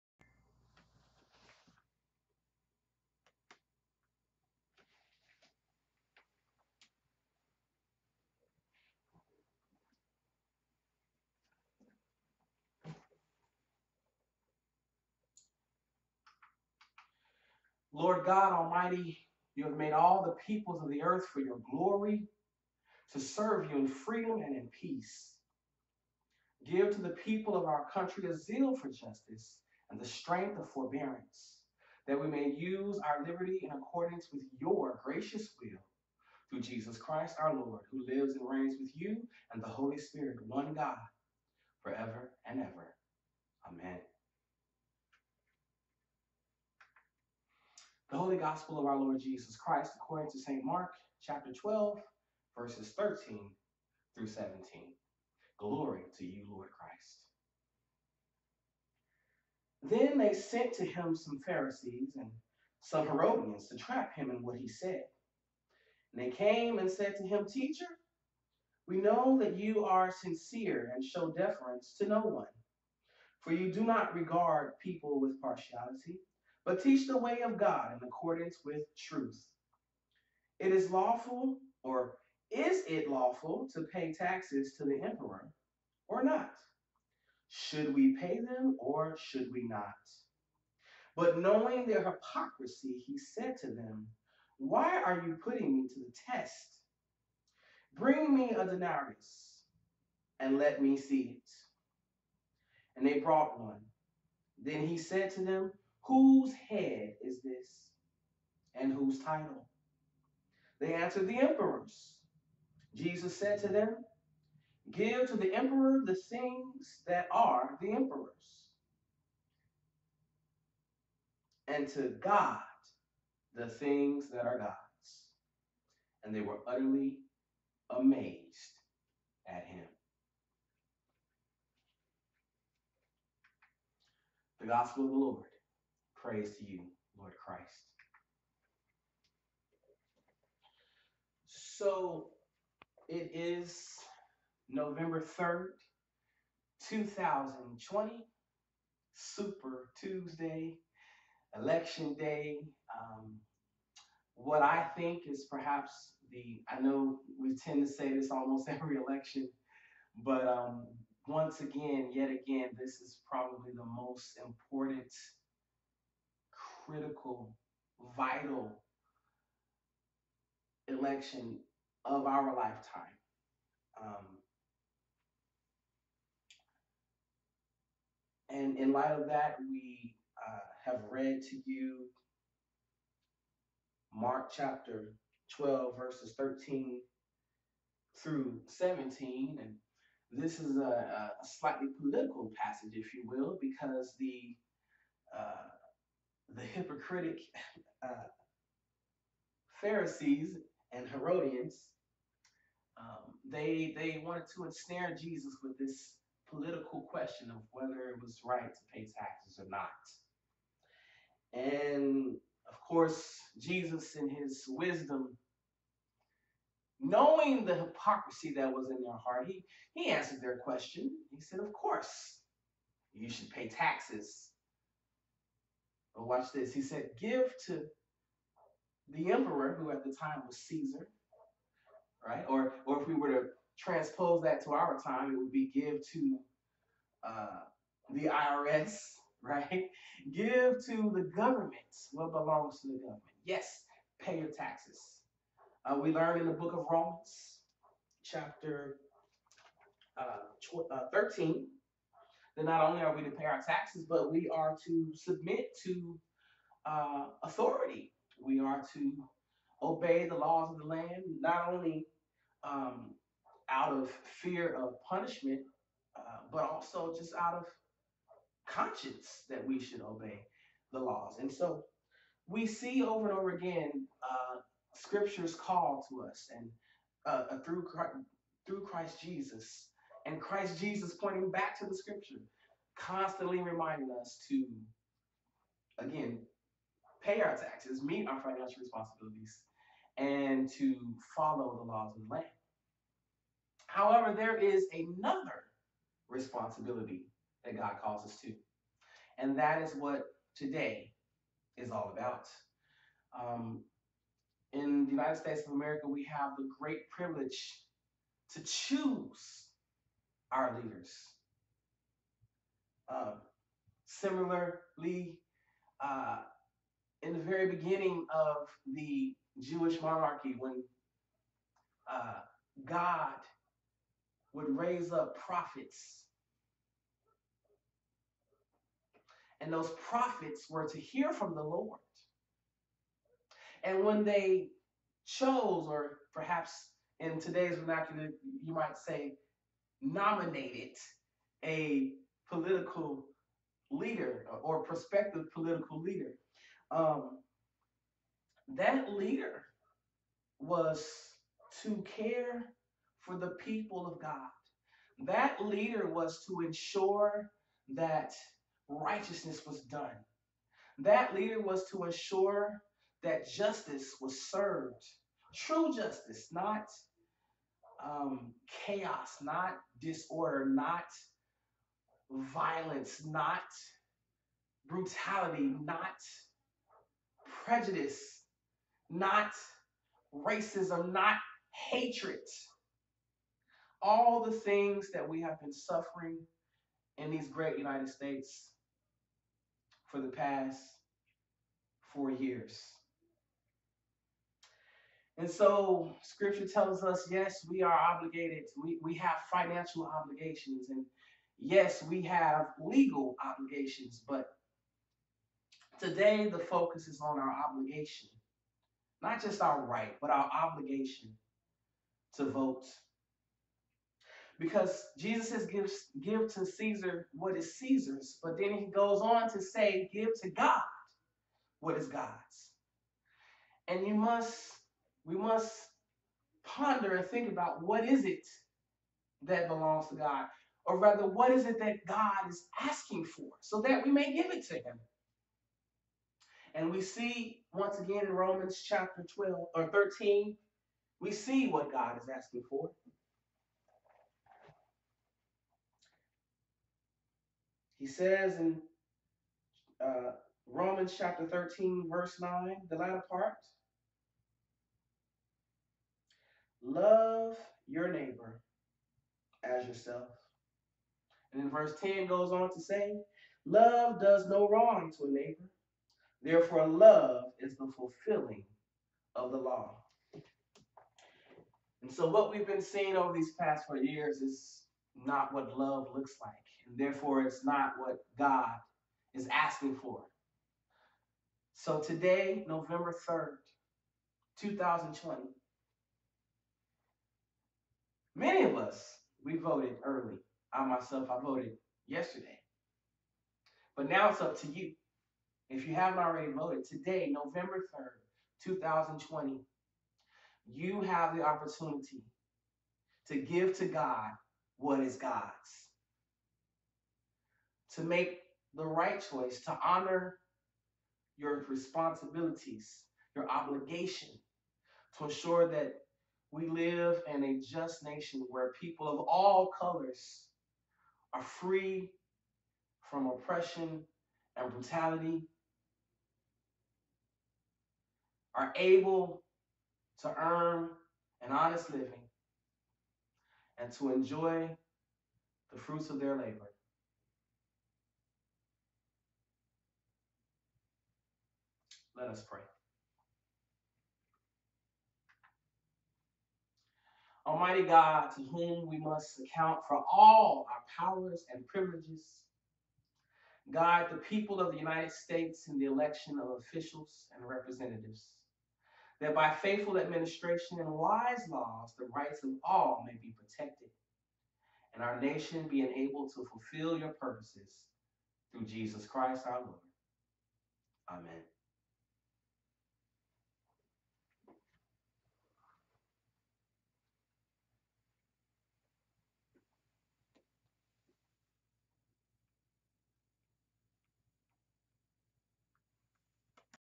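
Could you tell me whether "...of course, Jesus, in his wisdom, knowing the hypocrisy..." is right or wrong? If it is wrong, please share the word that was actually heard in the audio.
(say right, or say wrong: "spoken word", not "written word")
right.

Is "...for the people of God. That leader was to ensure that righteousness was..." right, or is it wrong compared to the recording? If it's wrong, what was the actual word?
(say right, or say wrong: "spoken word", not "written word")
right.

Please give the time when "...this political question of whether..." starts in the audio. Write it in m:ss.
3:25.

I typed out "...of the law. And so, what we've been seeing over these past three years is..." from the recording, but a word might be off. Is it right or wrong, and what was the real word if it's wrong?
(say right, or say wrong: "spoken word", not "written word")
wrong: "four", not "three".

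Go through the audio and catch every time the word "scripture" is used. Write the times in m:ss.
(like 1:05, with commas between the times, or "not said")
4:34, 4:41, 6:36.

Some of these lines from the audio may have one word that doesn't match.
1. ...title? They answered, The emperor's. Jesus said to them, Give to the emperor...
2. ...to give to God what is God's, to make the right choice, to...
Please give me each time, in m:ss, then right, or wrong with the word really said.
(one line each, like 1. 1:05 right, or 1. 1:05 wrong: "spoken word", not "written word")
1. 1:49 right
2. 8:23 right.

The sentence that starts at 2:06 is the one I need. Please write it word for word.
And they were utterly amazed at him.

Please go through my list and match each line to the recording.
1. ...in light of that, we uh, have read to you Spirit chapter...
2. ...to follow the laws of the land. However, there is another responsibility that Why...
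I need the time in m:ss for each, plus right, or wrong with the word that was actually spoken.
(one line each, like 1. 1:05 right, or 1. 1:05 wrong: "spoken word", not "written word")
1. 2:58 wrong: "Mark", not "Spirit"
2. 4:50 wrong: "God", not "Why".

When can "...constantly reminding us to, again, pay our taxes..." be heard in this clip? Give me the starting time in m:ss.
4:42.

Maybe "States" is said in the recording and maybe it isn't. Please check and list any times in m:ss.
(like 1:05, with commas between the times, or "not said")
5:05, 6:28, 9:15.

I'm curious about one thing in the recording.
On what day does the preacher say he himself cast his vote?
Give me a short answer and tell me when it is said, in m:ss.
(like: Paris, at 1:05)
yesterday, at 8:12.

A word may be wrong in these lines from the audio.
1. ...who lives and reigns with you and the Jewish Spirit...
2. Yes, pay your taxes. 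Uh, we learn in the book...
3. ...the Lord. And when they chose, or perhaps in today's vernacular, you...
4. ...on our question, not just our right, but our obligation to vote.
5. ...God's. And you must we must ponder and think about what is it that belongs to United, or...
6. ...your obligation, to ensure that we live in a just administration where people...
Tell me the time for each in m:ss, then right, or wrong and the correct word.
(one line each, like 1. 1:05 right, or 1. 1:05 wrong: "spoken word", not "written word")
1. 0:37 wrong: "Holy", not "Jewish"
2. 4:03 right
3. 5:31 right
4. 6:47 wrong: "obligation", not "question"
5. 7:02 wrong: "God", not "United"
6. 8:33 wrong: "nation", not "administration".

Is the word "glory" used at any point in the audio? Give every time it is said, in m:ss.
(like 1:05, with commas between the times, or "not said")
0:21, 0:55.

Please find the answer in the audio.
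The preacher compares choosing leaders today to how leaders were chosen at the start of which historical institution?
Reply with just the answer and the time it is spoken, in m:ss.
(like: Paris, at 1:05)
Jewish monarchy, at 5:19.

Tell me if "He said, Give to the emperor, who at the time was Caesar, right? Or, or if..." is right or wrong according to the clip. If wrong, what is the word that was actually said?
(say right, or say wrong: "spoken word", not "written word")
right.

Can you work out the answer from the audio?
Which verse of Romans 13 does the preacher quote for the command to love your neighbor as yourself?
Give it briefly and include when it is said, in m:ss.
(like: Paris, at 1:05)
verse 9, at 7:32.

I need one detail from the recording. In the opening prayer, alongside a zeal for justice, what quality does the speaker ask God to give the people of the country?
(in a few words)
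strength of forbearance.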